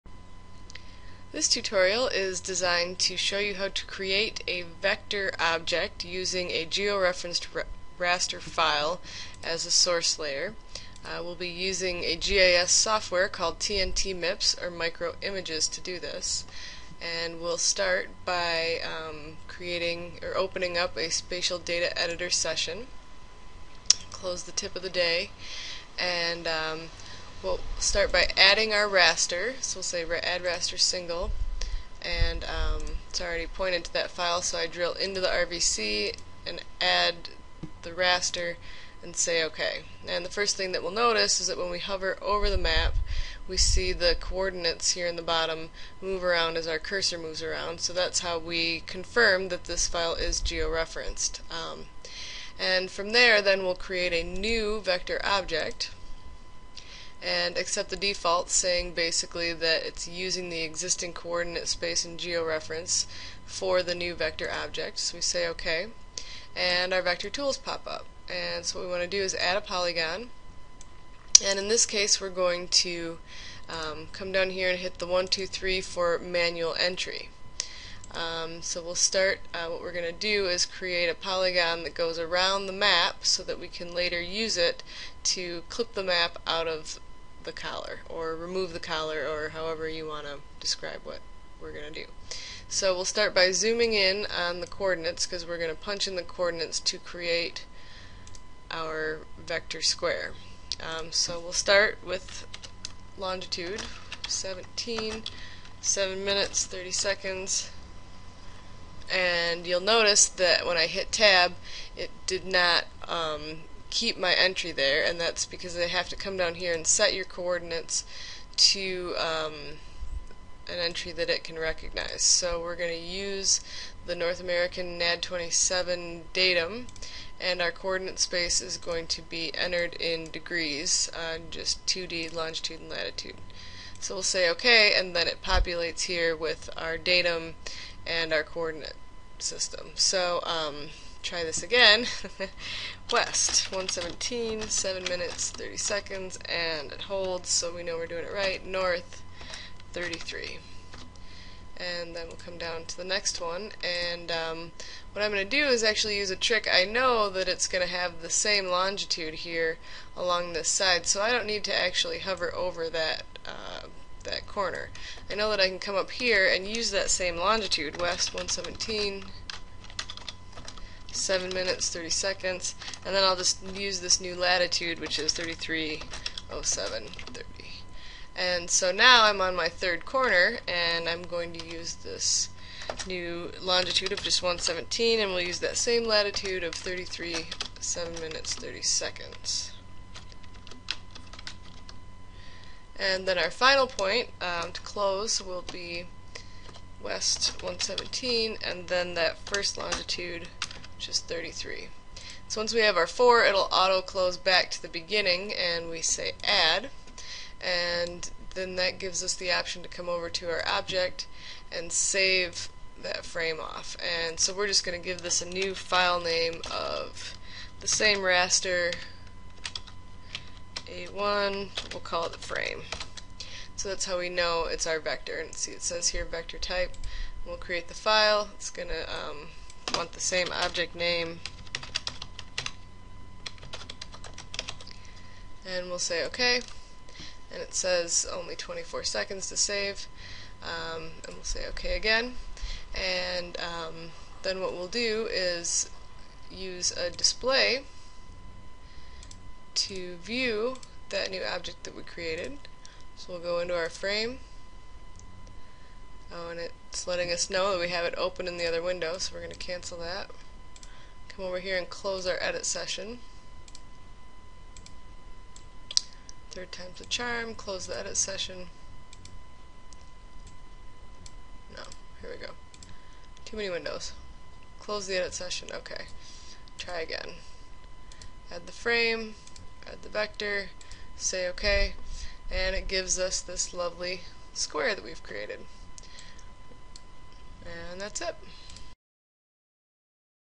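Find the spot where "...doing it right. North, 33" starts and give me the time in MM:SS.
02:28.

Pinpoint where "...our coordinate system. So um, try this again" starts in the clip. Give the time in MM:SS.
02:18.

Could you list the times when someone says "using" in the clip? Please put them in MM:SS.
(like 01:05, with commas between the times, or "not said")
00:06, 00:11, 01:00.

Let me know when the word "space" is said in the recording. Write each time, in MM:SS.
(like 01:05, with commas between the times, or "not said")
01:01, 02:08.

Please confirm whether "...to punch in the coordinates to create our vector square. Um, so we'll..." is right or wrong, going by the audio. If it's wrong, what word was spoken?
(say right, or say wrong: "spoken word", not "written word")
right.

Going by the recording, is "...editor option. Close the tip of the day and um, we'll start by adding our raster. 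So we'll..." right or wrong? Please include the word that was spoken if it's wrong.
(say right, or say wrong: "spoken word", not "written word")
wrong: "session", not "option".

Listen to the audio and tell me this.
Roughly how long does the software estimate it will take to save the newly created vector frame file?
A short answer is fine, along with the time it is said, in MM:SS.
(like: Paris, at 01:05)
24 seconds, at 03:58.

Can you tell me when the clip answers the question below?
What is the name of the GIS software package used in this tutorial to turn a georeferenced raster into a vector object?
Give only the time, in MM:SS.
00:13.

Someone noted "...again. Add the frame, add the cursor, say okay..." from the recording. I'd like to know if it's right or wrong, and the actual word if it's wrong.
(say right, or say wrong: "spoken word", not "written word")
wrong: "vector", not "cursor".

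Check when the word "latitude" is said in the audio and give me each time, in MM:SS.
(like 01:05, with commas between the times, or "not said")
02:12, 02:54, 03:06.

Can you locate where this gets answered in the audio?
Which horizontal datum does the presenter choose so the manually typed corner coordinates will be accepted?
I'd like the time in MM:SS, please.
02:04.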